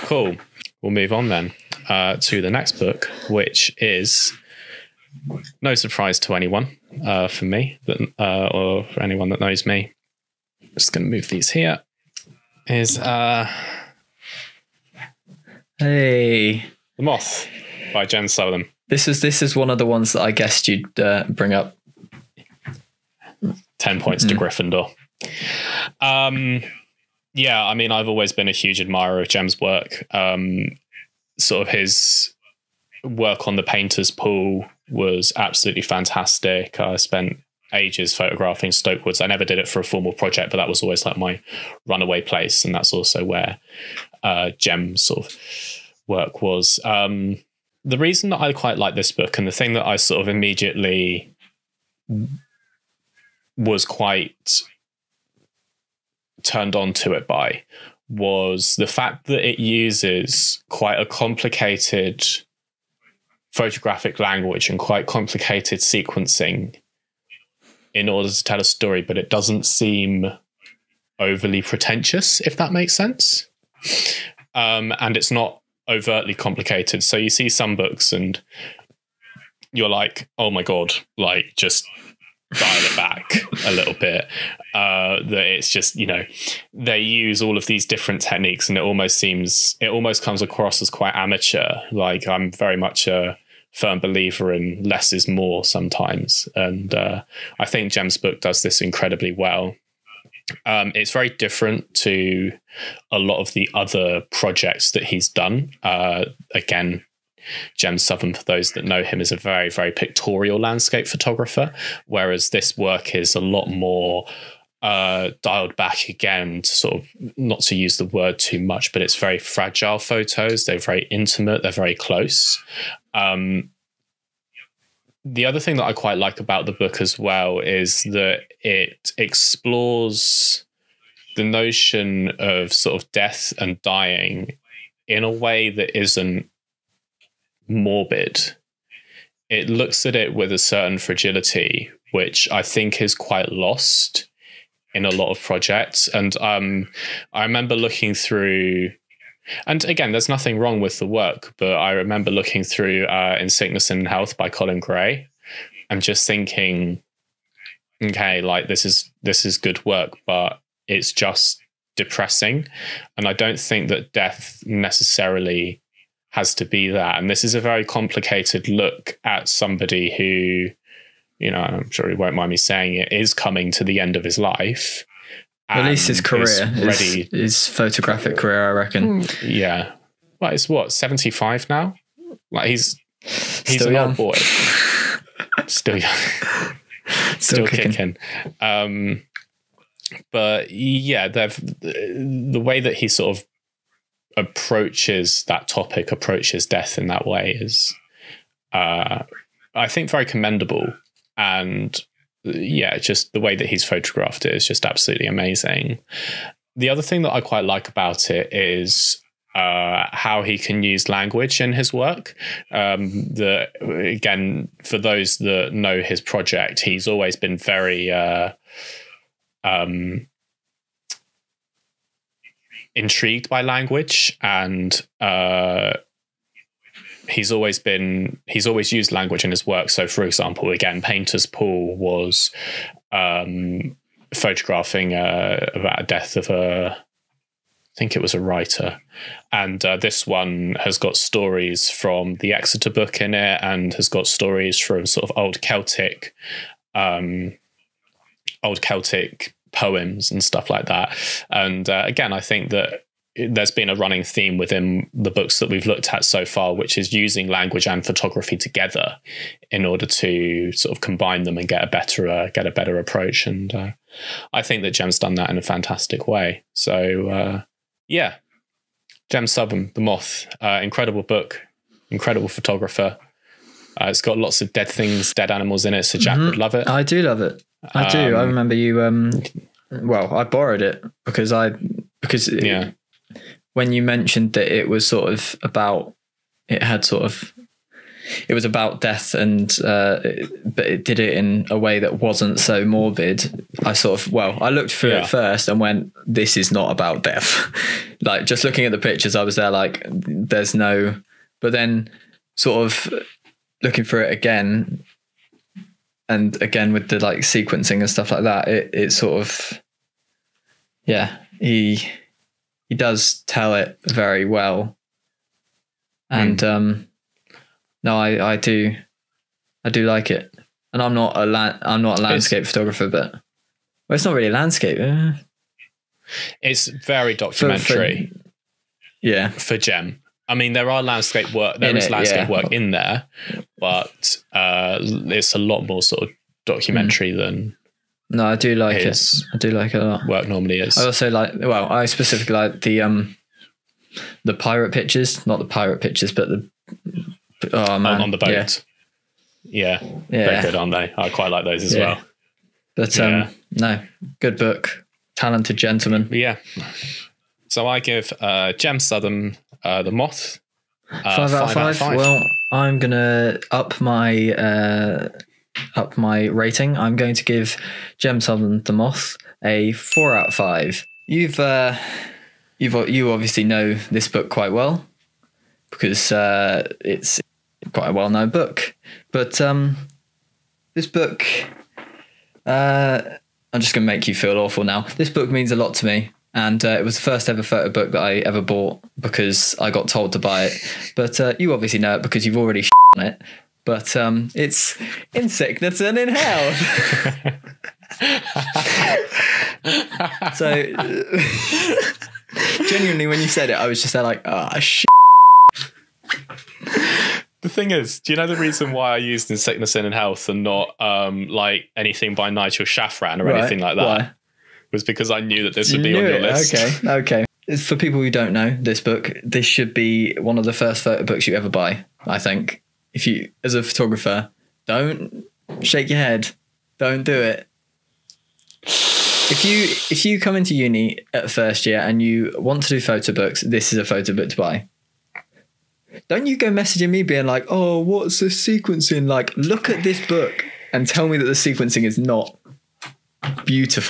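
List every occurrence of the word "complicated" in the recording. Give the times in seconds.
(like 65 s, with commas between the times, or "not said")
61 s, 65 s, 76 s, 167 s.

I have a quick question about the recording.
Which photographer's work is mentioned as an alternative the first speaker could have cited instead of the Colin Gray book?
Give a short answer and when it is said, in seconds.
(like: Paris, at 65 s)
Nigel Shafran, at 412 s.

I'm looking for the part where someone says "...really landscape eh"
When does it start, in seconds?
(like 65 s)
324 s.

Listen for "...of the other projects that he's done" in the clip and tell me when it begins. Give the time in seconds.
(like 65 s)
103 s.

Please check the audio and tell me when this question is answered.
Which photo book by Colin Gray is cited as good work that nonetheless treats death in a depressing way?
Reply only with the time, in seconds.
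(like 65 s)
153 s.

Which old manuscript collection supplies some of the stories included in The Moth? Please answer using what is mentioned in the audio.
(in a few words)
The Exeter Book.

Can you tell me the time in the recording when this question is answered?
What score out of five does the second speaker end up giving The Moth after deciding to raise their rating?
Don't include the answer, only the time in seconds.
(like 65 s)
369 s.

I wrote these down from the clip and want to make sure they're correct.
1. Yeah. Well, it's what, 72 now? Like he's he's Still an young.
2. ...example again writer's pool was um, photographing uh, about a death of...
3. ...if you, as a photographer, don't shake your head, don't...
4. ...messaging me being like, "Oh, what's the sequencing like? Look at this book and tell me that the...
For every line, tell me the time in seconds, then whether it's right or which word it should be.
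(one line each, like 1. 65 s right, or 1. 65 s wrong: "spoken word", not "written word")
1. 179 s wrong: "75", not "72"
2. 230 s wrong: "painter", not "writer"
3. 423 s right
4. 436 s right.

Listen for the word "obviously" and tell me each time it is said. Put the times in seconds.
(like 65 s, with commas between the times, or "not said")
373 s, 391 s.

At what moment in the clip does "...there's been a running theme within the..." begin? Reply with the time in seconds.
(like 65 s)
253 s.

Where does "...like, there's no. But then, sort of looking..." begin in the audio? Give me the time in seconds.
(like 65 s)
299 s.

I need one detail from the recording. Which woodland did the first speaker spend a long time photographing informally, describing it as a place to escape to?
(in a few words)
Stoke Woods.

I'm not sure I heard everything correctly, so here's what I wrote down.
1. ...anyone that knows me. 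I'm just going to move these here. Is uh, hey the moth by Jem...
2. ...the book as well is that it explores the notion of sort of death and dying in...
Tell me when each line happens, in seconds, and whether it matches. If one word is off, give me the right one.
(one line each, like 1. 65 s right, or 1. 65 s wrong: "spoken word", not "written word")
1. 9 s right
2. 126 s right.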